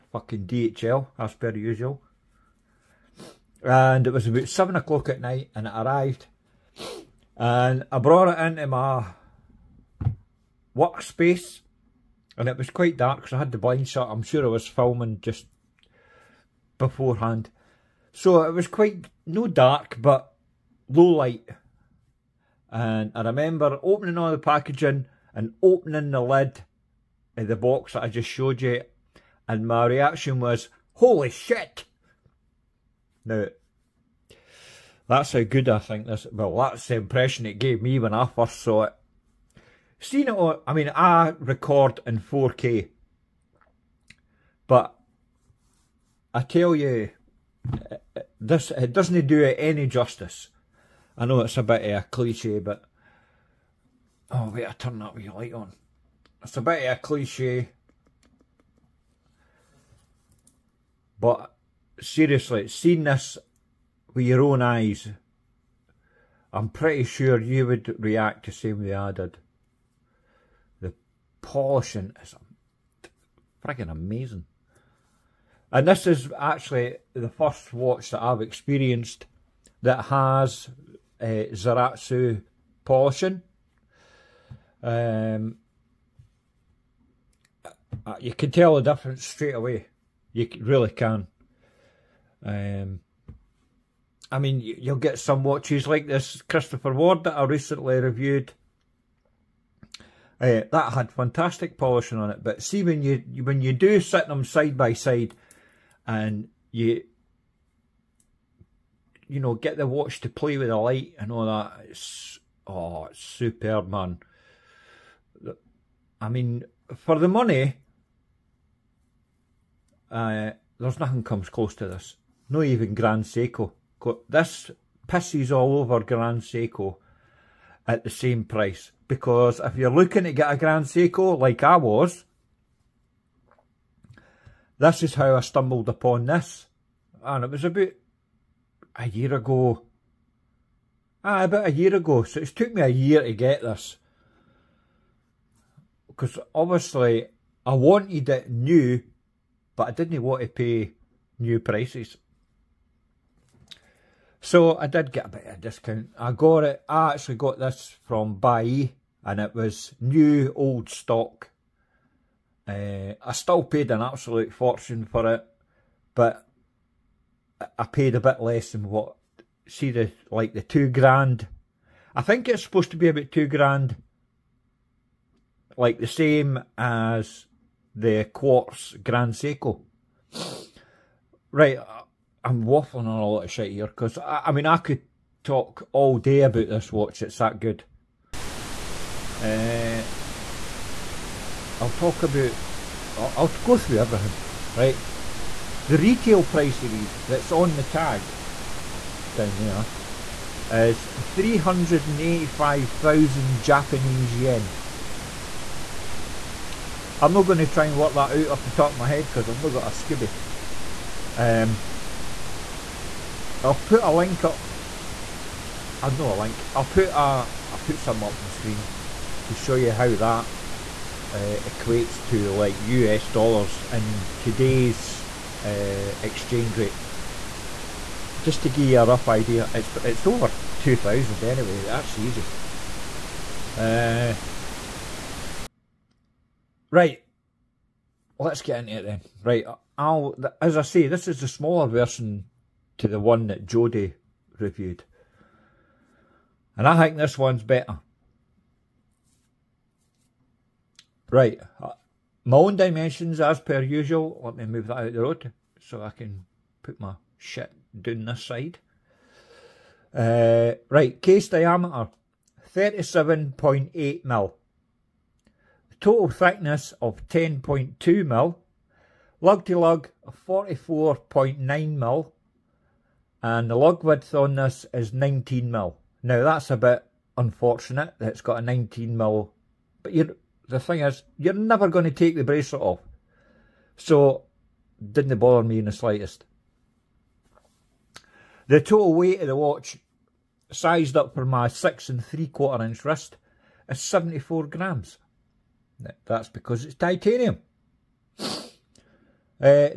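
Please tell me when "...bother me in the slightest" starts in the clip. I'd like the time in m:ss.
4:45.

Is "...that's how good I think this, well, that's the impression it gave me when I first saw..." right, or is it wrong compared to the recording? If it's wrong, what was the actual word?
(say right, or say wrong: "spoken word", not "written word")
right.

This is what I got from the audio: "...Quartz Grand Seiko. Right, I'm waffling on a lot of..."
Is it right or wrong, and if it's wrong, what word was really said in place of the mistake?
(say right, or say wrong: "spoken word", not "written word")
right.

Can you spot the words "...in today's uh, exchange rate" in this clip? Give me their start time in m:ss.
3:43.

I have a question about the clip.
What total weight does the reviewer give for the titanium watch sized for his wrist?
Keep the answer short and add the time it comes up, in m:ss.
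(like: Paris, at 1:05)
74 grams, at 4:54.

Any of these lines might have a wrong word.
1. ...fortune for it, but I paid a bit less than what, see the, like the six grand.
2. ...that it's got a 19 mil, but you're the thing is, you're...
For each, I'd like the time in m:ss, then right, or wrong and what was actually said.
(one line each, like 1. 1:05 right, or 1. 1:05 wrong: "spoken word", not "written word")
1. 2:44 wrong: "two", not "six"
2. 4:38 right.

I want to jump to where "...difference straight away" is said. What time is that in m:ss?
1:28.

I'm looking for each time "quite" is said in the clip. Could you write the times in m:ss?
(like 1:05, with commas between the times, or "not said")
0:12, 0:18.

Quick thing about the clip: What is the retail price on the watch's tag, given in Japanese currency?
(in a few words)
385,000 yen.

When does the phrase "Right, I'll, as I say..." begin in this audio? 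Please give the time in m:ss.
3:59.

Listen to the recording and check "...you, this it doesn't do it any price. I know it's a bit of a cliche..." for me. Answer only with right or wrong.
wrong.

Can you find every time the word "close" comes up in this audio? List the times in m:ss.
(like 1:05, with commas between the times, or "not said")
2:01.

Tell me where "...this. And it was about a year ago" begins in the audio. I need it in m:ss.
2:16.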